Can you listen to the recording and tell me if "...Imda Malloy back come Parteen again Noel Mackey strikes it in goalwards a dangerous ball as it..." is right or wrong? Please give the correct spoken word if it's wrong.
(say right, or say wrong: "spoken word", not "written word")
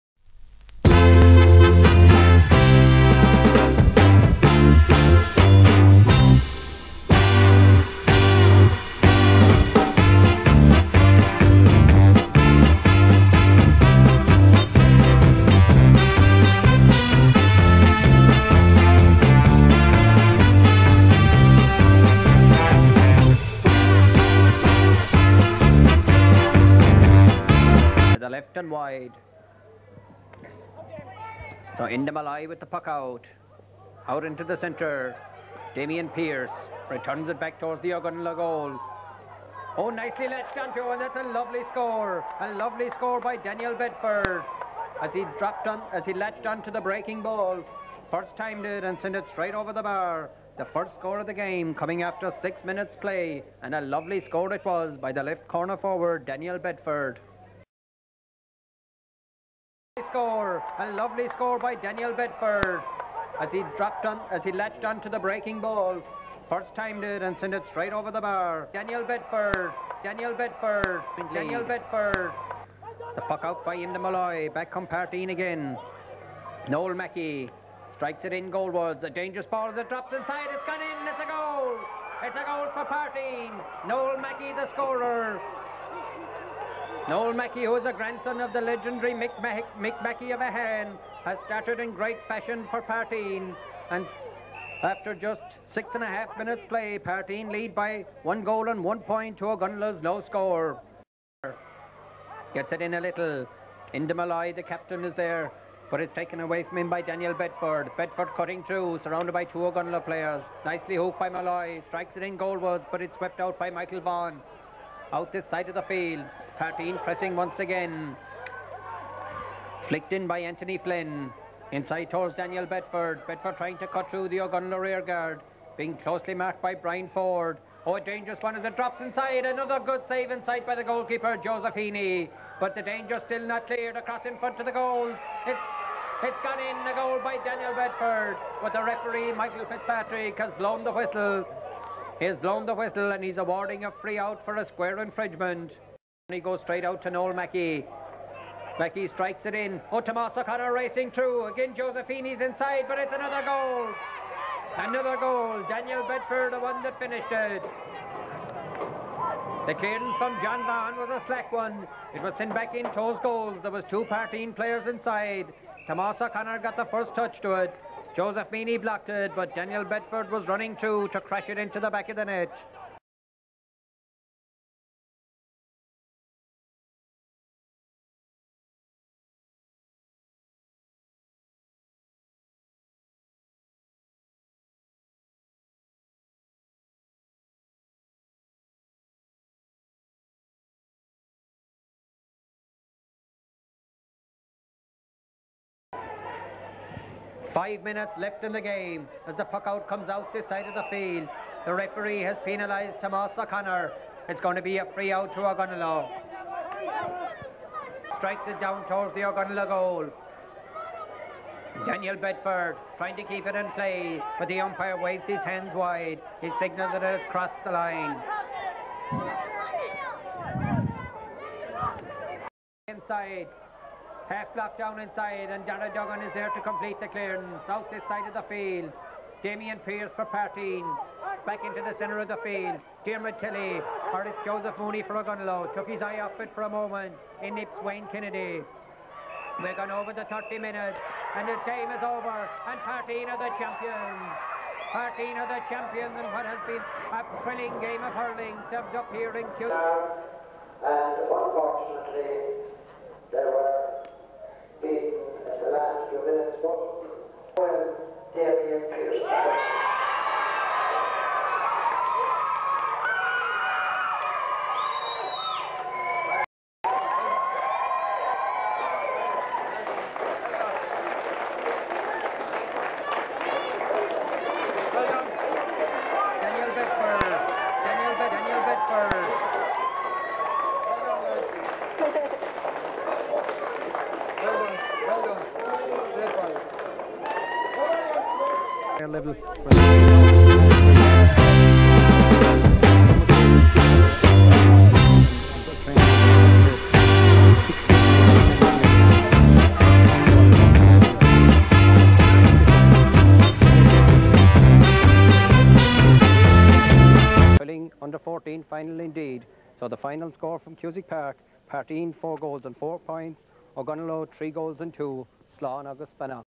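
right.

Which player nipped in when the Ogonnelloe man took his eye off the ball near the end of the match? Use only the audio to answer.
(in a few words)
Wayne Kennedy.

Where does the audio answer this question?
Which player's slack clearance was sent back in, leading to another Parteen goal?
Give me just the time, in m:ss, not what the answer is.
2:40.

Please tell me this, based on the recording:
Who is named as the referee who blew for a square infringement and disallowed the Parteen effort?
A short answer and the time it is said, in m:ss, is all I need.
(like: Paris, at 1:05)
Michael Fitzpatrick, at 2:19.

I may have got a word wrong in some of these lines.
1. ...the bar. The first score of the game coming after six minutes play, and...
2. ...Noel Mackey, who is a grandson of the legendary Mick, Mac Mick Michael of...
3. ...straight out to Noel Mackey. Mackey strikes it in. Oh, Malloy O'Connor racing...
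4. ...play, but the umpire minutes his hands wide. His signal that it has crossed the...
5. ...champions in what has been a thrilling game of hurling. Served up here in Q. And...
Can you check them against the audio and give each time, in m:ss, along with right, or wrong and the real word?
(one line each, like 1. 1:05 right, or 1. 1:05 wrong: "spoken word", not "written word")
1. 0:49 right
2. 1:27 wrong: "Mackey", not "Michael"
3. 2:26 wrong: "Tomas", not "Malloy"
4. 3:33 wrong: "waves", not "minutes"
5. 4:05 right.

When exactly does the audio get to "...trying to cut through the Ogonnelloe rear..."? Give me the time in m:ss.
2:03.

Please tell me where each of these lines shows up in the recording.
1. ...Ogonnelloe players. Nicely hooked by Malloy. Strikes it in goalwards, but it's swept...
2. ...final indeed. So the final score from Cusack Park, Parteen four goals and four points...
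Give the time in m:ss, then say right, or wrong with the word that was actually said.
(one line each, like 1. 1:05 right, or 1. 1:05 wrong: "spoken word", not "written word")
1. 1:49 right
2. 5:08 right.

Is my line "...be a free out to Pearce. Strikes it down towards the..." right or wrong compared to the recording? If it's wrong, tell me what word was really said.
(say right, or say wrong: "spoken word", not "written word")
wrong: "Ogonnelloe", not "Pearce".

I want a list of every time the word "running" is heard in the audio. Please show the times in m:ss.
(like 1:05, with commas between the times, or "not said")
2:50.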